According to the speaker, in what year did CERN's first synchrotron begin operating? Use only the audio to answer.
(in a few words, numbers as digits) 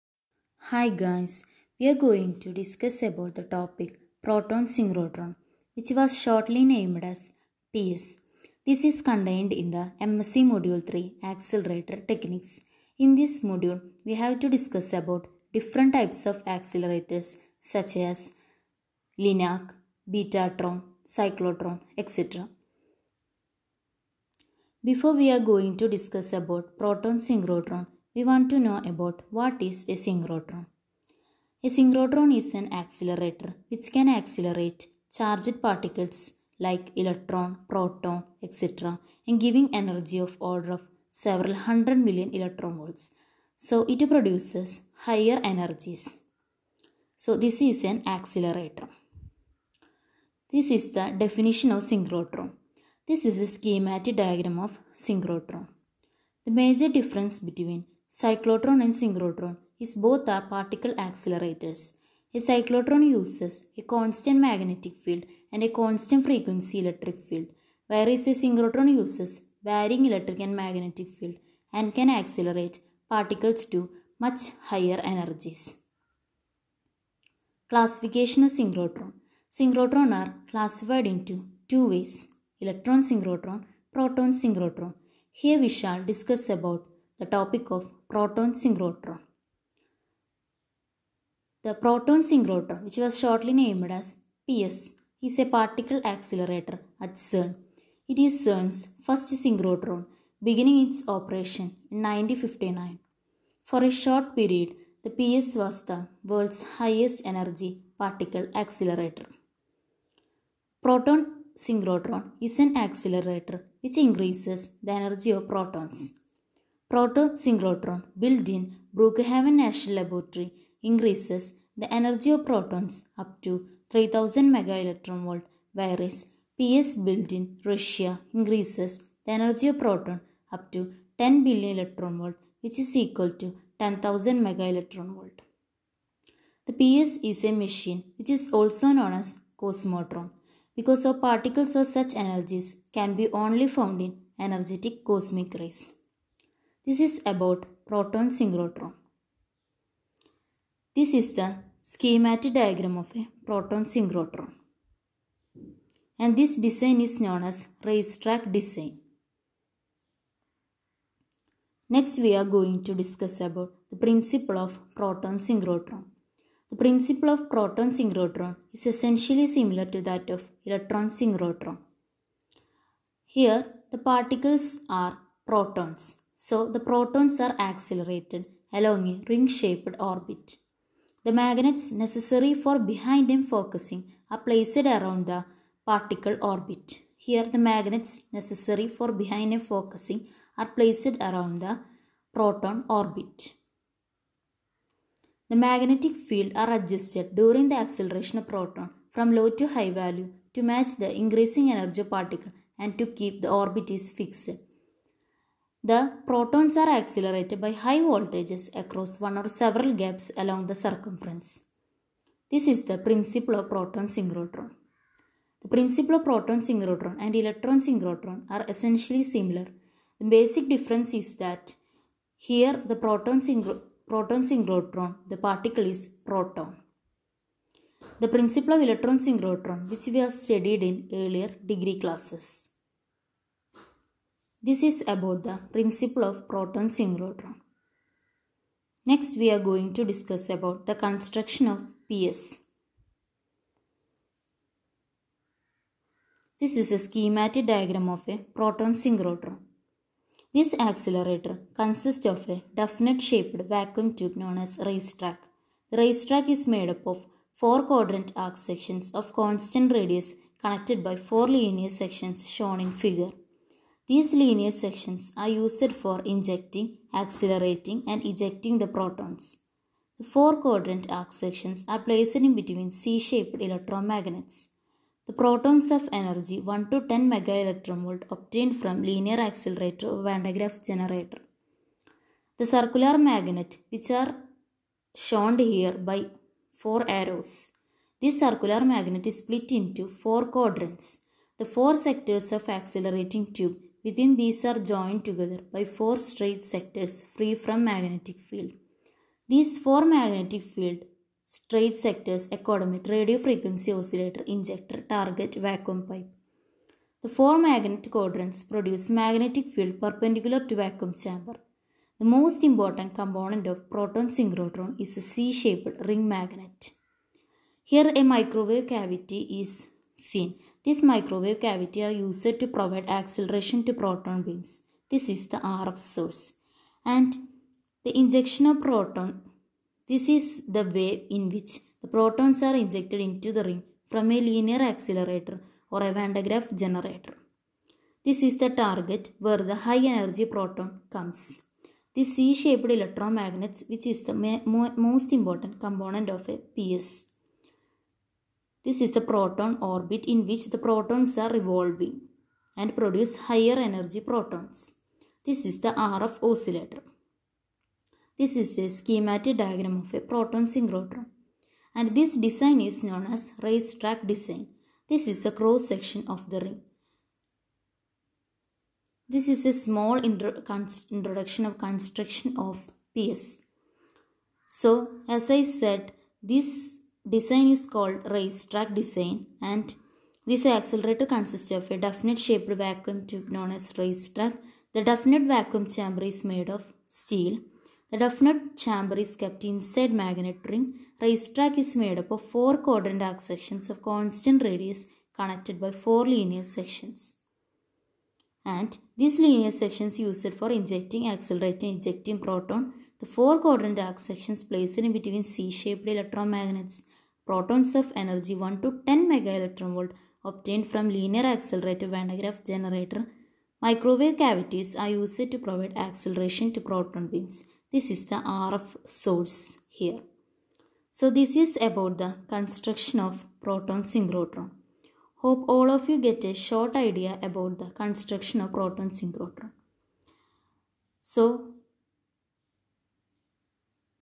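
1959.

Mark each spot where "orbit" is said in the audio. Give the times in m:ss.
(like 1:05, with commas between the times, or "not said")
2:59, 3:06, 3:12, 3:23, 5:49.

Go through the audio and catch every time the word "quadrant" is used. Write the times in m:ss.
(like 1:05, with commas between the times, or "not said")
4:17, 4:30, 4:50, 5:08, 6:32, 6:43.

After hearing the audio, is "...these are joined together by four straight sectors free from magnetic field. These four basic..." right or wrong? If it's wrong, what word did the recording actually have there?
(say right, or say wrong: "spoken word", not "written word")
wrong: "magnetic", not "basic".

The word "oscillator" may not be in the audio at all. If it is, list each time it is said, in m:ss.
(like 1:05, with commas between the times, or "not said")
5:03, 5:56.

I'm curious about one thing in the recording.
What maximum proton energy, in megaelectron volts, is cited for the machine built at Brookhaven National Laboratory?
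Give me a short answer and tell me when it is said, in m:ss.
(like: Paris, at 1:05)
3000 MeV, at 2:03.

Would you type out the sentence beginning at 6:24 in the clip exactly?
The definite vacuum chamber is made of steel.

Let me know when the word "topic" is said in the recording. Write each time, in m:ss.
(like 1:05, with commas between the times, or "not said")
0:03, 1:27.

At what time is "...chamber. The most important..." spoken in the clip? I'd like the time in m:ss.
5:11.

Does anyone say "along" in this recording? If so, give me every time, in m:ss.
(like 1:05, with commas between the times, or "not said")
2:58, 3:30.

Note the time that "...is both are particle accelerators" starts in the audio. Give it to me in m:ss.
0:59.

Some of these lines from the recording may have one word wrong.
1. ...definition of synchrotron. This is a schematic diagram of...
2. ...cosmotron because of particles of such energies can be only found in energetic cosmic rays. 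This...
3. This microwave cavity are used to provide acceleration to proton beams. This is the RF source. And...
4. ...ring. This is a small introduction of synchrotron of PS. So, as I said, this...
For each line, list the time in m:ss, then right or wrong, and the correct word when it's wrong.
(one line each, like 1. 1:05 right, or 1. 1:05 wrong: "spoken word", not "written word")
1. 0:51 right
2. 2:19 right
3. 5:20 right
4. 6:06 wrong: "construction", not "synchrotron".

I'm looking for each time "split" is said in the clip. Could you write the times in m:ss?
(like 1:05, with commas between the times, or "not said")
4:49.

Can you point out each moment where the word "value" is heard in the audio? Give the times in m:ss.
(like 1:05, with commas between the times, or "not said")
3:19.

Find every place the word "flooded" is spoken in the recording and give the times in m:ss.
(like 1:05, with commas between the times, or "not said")
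not said.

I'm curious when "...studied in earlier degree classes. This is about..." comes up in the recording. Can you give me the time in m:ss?
3:50.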